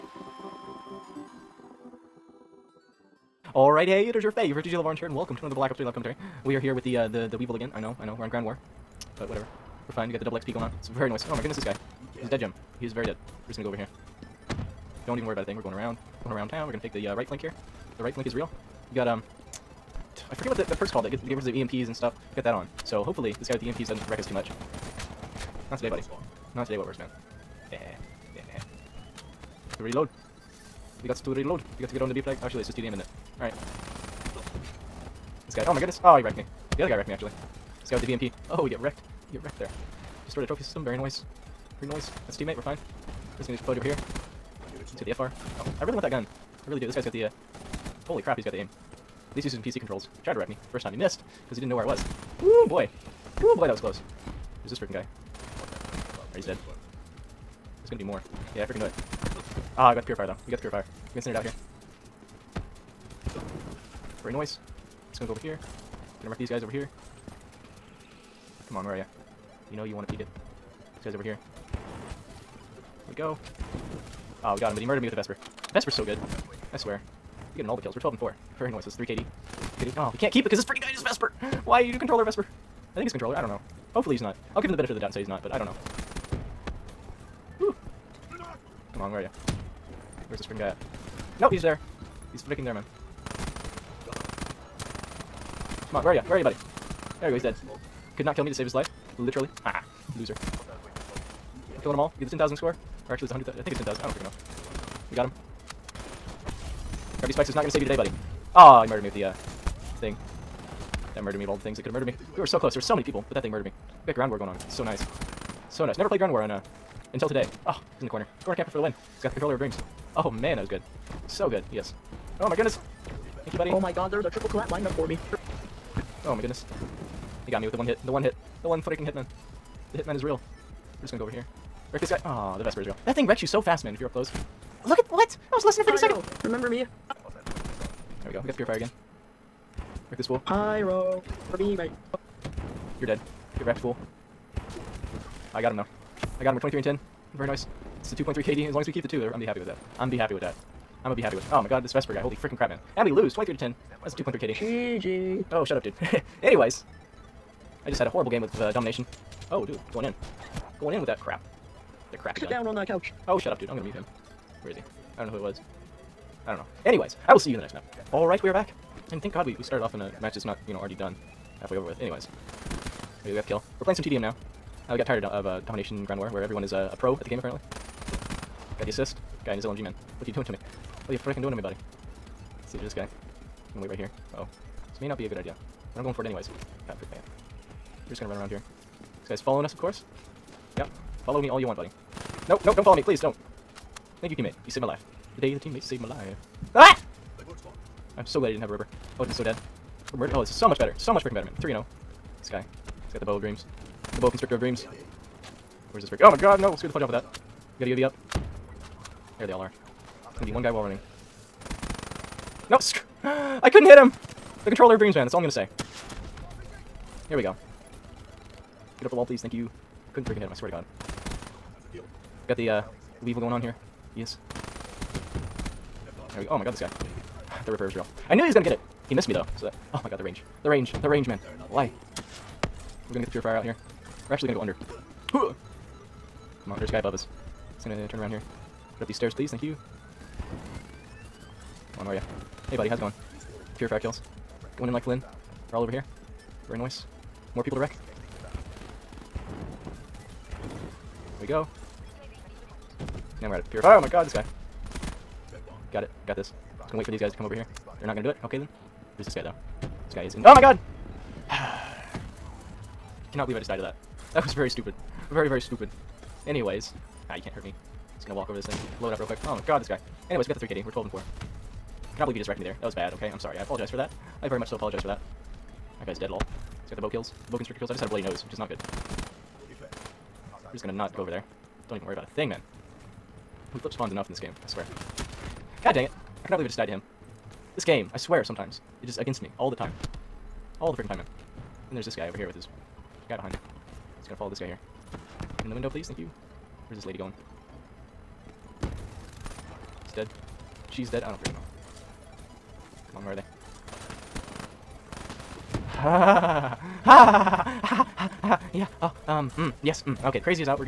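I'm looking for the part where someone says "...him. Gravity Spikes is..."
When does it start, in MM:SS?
01:45.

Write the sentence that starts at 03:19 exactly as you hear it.
I would have been so dead.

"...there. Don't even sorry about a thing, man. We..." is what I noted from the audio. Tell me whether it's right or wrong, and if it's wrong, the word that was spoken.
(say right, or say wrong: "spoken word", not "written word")
wrong: "worry", not "sorry".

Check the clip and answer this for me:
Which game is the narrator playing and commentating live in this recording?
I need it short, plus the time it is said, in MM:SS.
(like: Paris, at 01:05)
Black Ops 3, at 00:05.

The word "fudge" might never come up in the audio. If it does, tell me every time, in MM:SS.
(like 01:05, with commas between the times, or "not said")
00:43, 03:26.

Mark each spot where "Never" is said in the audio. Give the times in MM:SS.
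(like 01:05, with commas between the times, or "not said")
01:55.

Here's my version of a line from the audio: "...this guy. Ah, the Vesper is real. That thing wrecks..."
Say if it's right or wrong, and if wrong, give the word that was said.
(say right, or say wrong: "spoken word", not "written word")
right.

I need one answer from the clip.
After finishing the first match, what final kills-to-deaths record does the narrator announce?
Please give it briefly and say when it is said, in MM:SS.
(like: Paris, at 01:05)
23 and 10, at 02:26.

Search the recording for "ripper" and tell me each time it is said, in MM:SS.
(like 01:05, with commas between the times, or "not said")
03:18, 03:47.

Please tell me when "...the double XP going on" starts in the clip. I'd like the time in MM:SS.
00:10.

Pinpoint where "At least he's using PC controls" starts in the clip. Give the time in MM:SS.
00:49.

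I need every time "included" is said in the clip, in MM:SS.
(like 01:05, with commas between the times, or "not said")
not said.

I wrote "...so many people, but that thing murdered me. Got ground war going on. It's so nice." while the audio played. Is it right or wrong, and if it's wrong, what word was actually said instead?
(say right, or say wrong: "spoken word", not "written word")
right.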